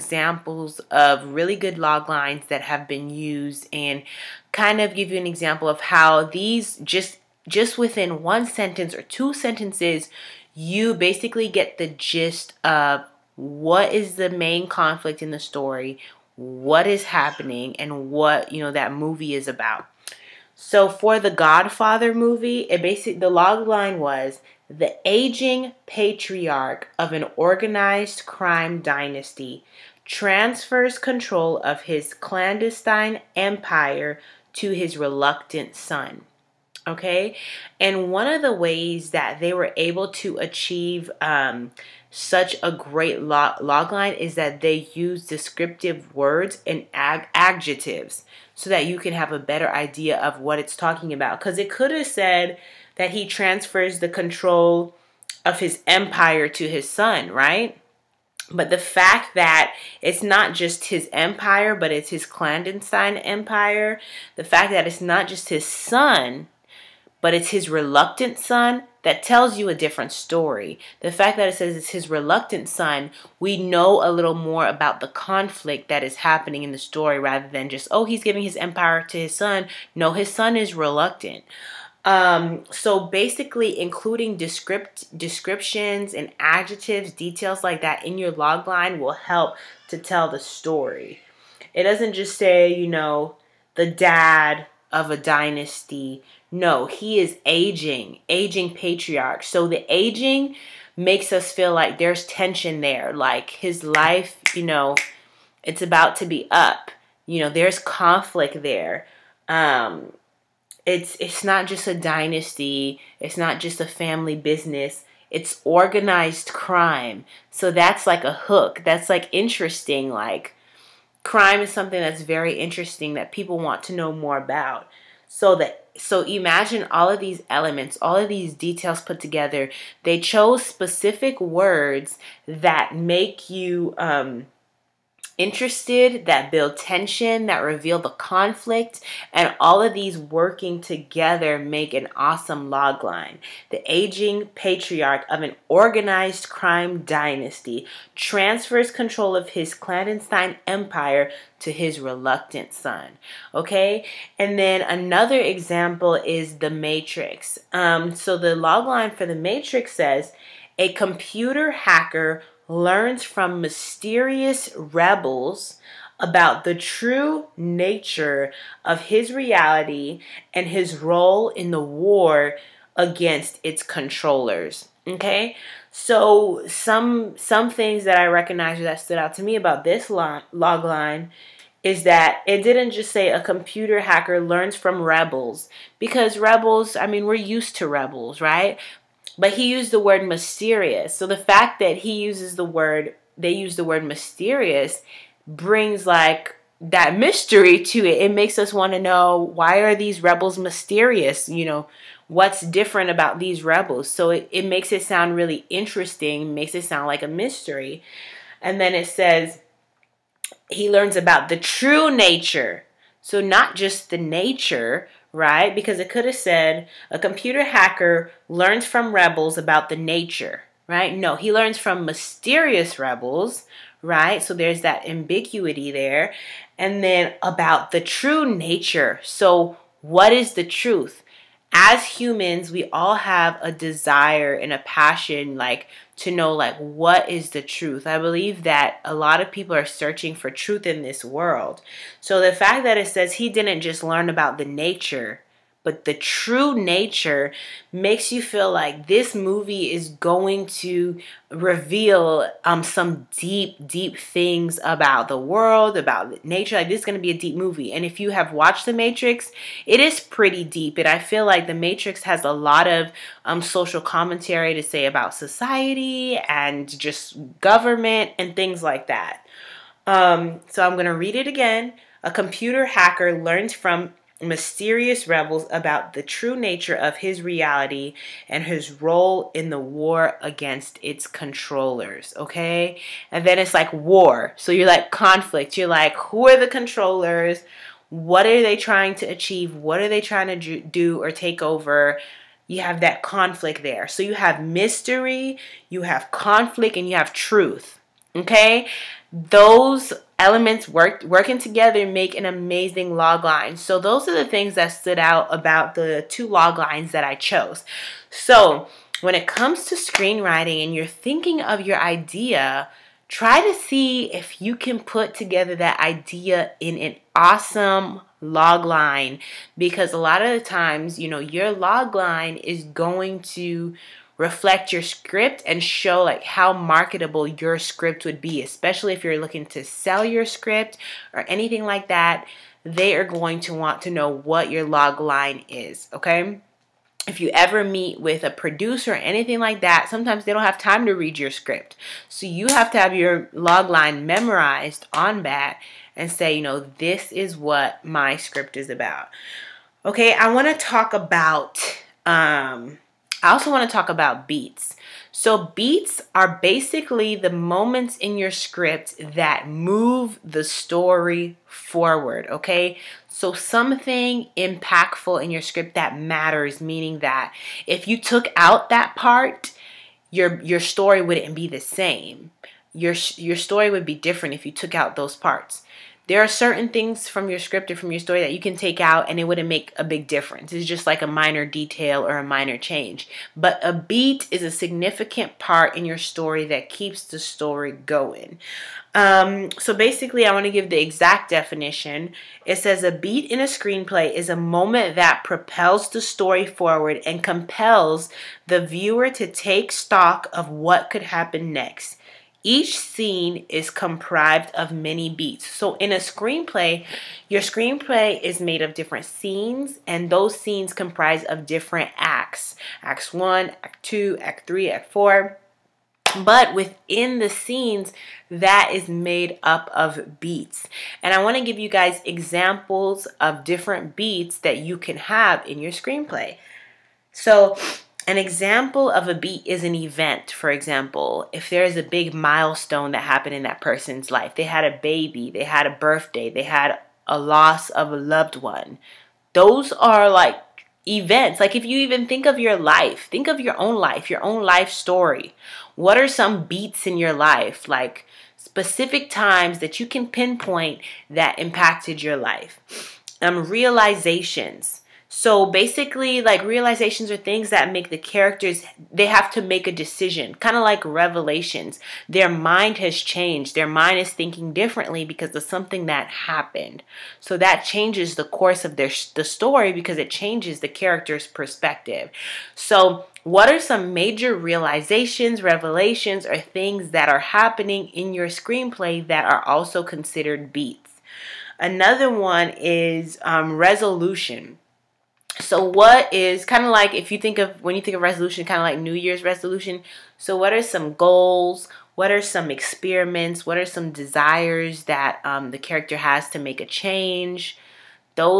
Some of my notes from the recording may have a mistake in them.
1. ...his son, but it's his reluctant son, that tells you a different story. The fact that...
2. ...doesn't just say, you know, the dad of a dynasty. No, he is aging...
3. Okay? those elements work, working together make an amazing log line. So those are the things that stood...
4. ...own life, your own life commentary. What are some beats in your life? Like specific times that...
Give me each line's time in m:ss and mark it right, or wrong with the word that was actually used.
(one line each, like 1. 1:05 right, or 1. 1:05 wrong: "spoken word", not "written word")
1. 1:05 right
2. 1:31 right
3. 4:58 right
4. 7:23 wrong: "story", not "commentary".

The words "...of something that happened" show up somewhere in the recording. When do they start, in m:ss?
7:45.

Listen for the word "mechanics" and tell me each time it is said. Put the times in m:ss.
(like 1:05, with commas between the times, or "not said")
not said.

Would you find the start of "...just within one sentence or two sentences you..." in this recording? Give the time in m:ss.
0:07.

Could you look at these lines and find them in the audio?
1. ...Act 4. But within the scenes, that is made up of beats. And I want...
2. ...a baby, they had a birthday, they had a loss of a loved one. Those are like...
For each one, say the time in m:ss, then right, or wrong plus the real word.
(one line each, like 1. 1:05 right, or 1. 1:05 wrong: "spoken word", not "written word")
1. 6:54 right
2. 7:14 right.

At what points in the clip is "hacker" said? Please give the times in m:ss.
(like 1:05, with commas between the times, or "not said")
2:41, 3:03, 3:37, 4:32.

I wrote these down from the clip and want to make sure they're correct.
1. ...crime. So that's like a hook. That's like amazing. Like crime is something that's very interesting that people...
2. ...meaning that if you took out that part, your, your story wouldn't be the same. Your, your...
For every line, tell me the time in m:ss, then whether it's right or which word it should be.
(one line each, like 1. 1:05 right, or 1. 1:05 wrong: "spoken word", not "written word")
1. 1:56 wrong: "interesting", not "amazing"
2. 6:06 right.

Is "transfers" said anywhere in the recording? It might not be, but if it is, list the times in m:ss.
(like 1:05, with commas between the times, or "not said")
0:30, 0:53, 2:28.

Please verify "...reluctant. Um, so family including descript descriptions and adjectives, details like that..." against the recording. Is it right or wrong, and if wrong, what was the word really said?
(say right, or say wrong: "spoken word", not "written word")
wrong: "basically", not "family".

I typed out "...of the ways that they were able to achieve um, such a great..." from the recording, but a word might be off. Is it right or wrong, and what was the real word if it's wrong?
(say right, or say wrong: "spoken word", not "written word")
right.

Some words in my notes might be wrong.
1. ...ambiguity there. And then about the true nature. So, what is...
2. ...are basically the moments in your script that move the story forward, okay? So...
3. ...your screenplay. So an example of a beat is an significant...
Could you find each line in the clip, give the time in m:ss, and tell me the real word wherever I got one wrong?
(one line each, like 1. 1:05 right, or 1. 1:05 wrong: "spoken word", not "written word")
1. 3:45 right
2. 5:56 right
3. 7:05 wrong: "event", not "significant".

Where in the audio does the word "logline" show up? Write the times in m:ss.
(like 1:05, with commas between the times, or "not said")
2:22, 2:38.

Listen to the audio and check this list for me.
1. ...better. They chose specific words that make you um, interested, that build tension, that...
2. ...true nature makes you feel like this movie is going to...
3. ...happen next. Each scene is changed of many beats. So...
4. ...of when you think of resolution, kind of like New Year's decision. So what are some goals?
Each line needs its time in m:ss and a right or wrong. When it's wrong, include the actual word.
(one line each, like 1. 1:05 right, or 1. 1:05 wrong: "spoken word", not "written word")
1. 2:09 wrong: "together", not "better"
2. 4:06 right
3. 6:41 wrong: "comprised", not "changed"
4. 8:07 wrong: "resolution", not "decision".